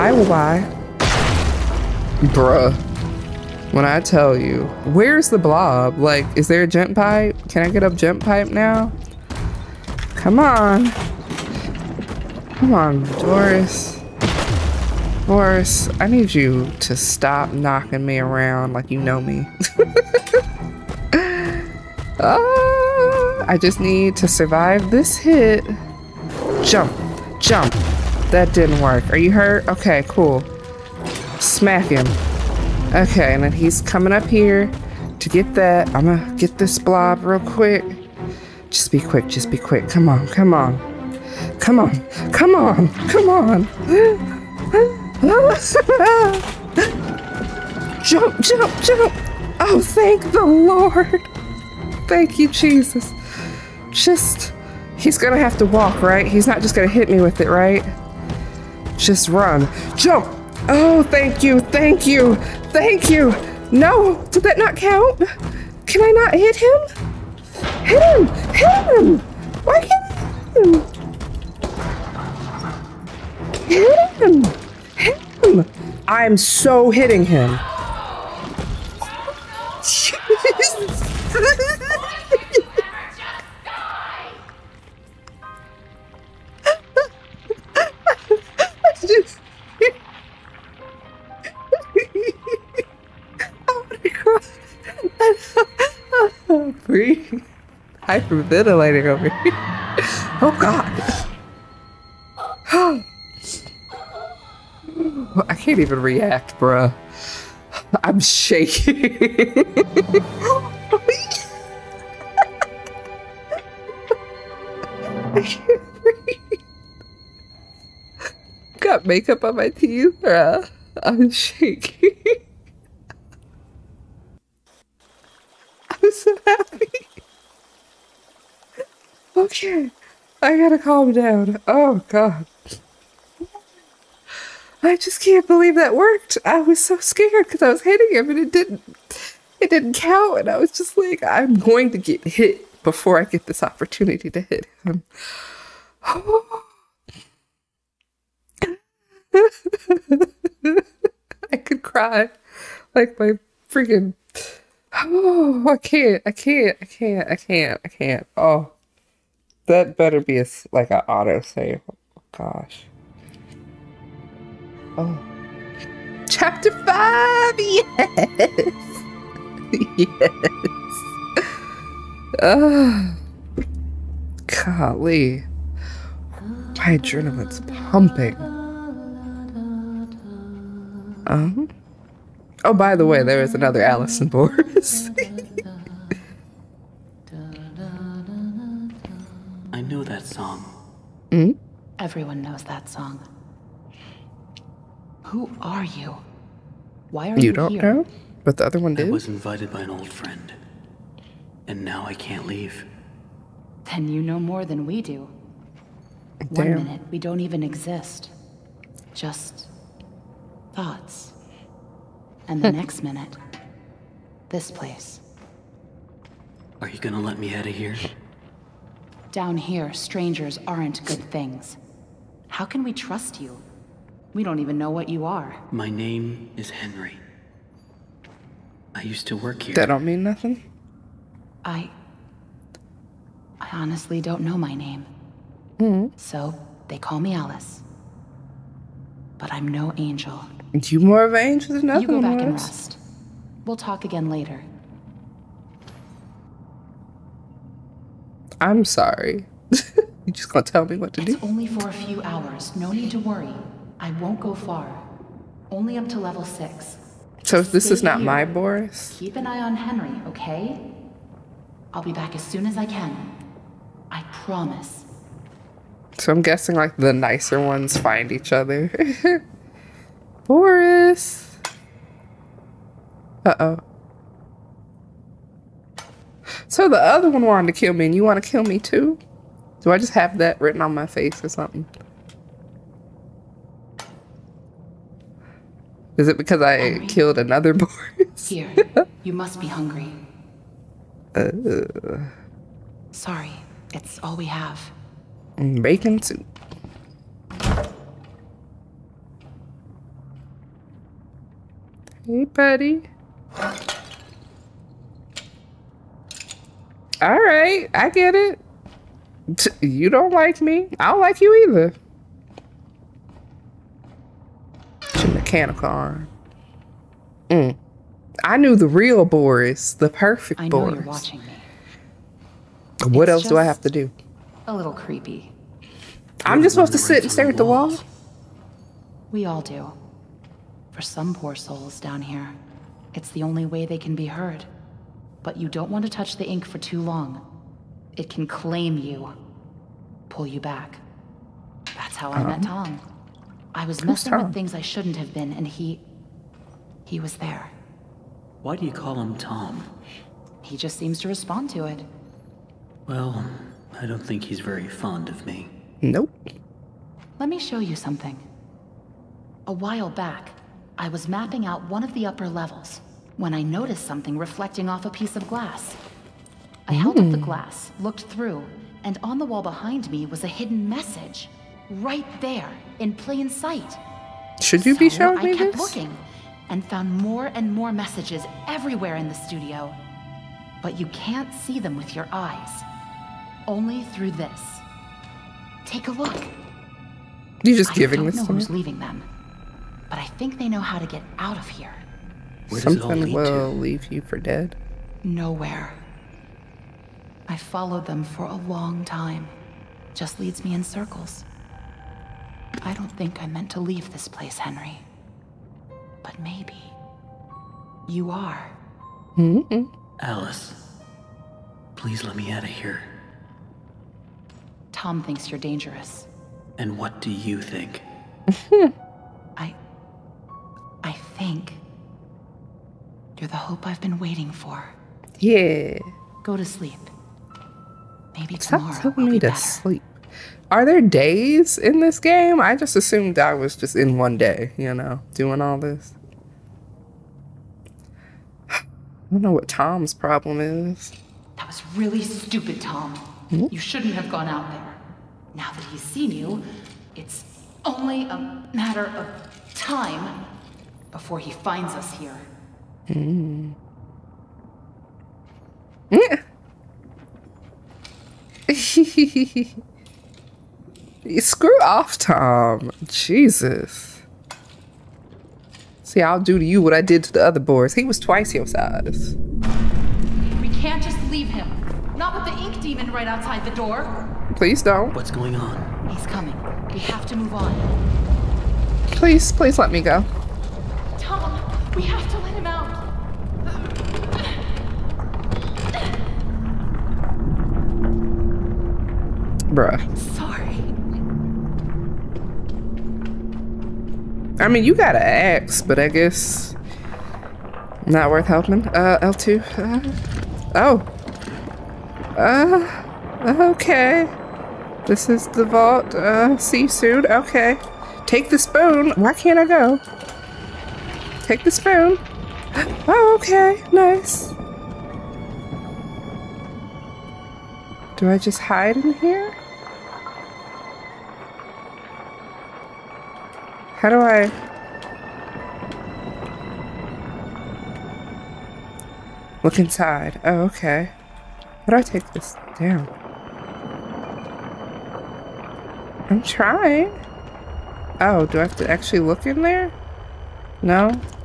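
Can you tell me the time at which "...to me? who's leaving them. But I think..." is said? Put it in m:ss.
6:28.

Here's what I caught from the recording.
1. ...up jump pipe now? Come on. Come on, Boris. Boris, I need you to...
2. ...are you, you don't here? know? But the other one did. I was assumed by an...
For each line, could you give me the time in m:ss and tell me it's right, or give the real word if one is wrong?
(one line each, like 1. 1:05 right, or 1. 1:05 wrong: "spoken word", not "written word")
1. 0:07 right
2. 3:17 wrong: "invited", not "assumed".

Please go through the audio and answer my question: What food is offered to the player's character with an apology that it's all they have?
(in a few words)
Bacon soup.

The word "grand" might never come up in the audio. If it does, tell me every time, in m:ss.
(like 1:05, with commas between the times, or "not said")
not said.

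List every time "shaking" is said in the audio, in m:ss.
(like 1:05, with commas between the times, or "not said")
1:48, 2:01.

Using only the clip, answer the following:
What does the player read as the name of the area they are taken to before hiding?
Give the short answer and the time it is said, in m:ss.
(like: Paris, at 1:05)
The vault, at 8:25.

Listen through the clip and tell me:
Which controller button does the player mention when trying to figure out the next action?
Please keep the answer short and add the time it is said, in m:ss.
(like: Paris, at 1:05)
L2, at 8:19.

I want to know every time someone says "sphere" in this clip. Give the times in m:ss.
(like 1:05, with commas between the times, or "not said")
not said.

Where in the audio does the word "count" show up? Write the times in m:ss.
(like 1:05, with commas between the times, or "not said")
1:04, 2:19.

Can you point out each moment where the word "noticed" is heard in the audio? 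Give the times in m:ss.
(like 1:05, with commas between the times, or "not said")
6:03.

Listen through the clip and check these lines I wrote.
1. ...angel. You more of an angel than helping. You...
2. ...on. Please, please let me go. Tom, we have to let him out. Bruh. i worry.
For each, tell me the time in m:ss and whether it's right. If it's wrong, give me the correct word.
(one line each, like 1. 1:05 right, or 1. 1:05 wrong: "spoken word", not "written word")
1. 3:59 wrong: "nothing", not "helping"
2. 7:57 wrong: "sorry", not "worry".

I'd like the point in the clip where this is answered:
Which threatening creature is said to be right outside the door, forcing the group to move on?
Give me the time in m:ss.
7:52.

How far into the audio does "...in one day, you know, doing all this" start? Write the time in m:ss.
7:13.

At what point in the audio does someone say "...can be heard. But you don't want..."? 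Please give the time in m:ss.
5:33.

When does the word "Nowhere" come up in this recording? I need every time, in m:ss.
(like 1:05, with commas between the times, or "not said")
6:35.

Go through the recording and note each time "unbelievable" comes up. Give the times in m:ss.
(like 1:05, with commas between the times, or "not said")
not said.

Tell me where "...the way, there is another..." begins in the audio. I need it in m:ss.
3:02.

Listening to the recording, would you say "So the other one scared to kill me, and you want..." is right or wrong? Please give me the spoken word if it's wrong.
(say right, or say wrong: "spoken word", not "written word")
wrong: "wanted", not "scared".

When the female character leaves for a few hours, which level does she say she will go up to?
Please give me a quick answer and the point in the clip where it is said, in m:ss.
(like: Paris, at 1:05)
Level six, at 4:16.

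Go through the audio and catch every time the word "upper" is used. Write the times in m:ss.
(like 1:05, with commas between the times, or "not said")
6:02.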